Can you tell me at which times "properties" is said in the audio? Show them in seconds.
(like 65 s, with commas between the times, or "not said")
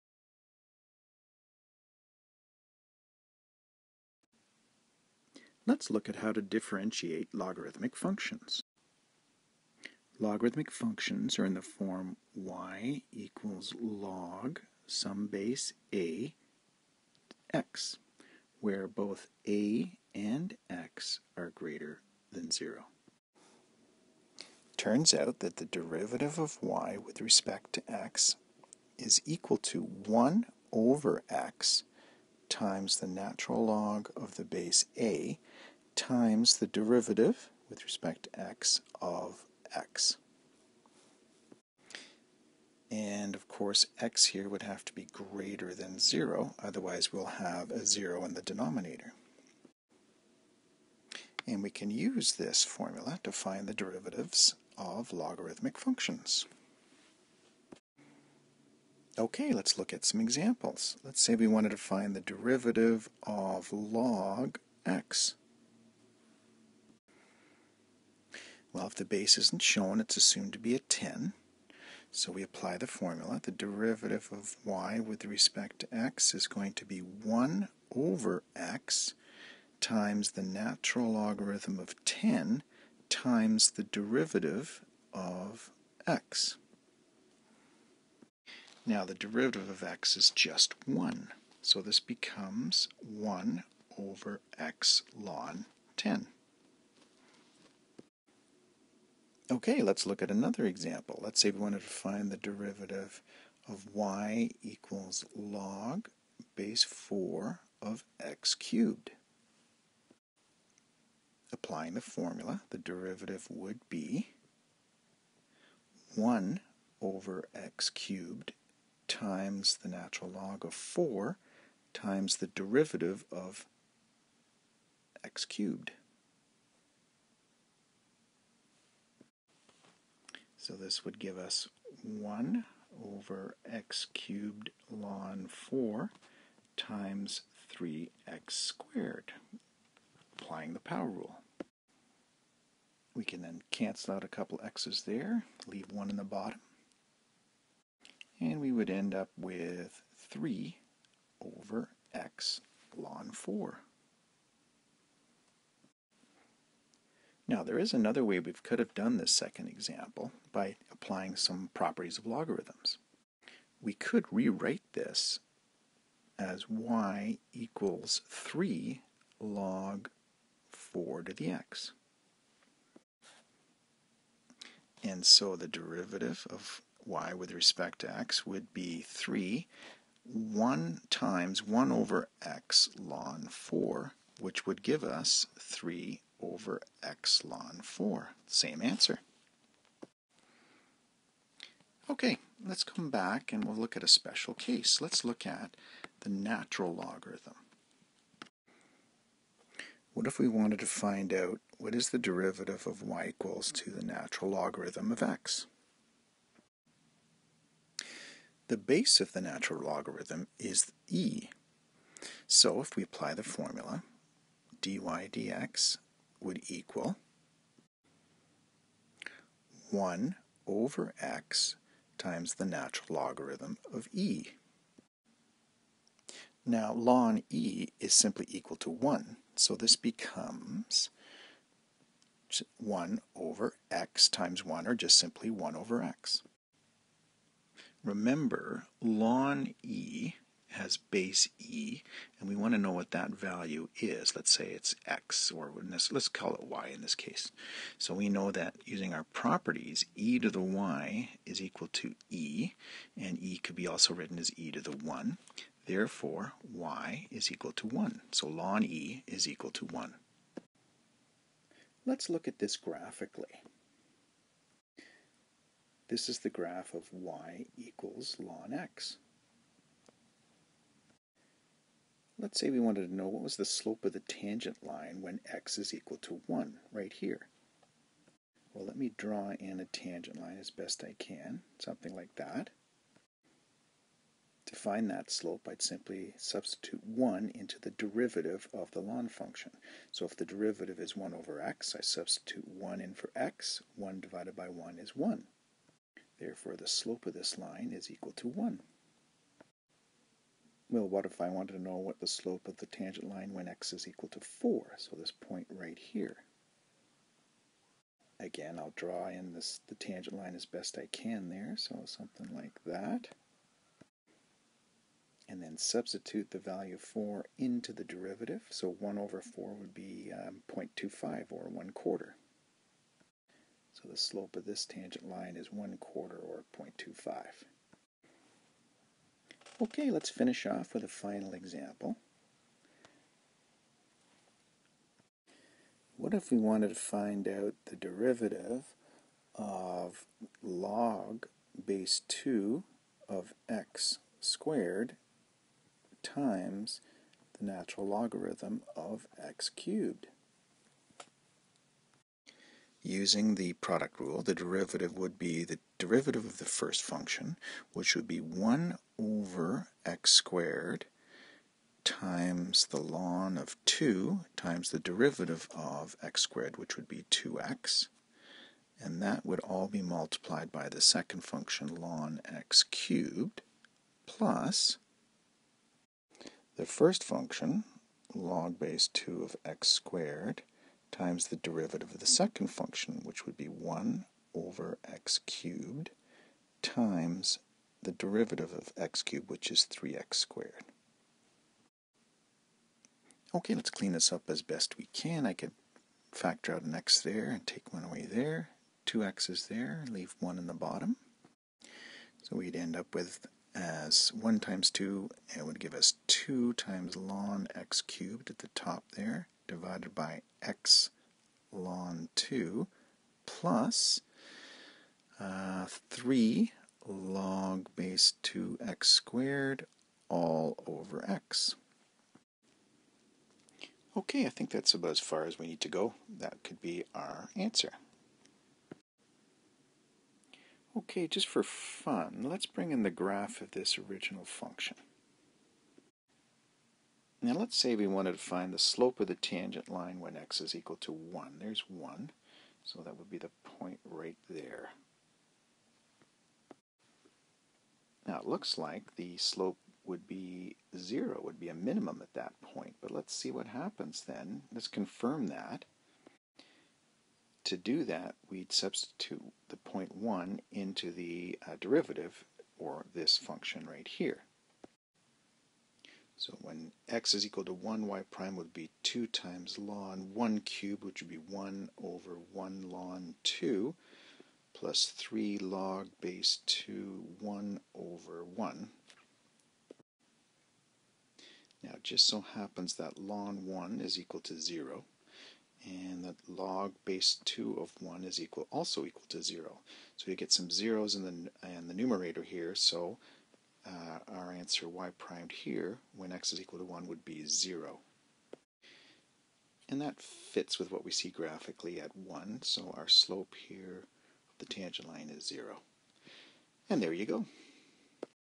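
161 s, 249 s.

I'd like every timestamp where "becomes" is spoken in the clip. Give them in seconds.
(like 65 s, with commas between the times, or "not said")
91 s, 229 s.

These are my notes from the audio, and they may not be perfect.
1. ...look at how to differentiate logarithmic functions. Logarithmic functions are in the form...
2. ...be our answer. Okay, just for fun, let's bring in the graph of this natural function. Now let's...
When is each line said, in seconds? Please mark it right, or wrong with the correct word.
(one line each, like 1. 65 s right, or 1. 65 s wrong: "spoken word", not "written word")
1. 5 s right
2. 426 s wrong: "original", not "natural".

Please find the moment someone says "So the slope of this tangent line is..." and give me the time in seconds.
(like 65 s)
323 s.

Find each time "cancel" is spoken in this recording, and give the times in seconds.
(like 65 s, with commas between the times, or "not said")
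143 s.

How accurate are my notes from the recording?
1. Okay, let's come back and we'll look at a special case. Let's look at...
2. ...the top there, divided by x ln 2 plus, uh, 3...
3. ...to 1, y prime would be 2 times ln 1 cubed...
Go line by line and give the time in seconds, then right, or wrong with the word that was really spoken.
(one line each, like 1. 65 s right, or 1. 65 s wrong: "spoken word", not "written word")
1. 192 s right
2. 408 s right
3. 467 s right.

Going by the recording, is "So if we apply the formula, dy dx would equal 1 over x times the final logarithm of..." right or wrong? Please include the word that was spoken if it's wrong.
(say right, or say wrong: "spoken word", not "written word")
wrong: "natural", not "final".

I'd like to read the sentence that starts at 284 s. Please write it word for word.
To find that slope, I'd simply substitute 1 into the derivative of the ln function.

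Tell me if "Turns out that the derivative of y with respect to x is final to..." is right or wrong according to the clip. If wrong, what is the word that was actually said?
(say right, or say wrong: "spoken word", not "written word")
wrong: "equal", not "final".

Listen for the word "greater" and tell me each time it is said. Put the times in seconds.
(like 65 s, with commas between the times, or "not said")
21 s, 45 s.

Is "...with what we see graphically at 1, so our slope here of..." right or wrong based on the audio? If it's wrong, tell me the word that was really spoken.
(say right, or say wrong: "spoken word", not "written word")
right.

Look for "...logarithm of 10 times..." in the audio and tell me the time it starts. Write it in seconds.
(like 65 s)
81 s.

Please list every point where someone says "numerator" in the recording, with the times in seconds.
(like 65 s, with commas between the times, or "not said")
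491 s.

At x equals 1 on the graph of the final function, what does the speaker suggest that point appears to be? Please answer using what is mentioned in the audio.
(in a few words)
a minimum.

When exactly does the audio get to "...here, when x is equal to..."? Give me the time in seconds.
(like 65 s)
495 s.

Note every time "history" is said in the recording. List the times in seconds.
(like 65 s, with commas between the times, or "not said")
not said.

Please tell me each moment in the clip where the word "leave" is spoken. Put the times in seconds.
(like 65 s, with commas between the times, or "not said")
145 s, 400 s.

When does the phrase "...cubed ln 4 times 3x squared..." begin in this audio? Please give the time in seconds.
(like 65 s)
134 s.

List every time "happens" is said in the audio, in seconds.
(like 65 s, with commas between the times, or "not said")
453 s, 482 s.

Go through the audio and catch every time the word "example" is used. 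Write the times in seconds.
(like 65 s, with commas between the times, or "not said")
60 s, 100 s, 159 s, 331 s.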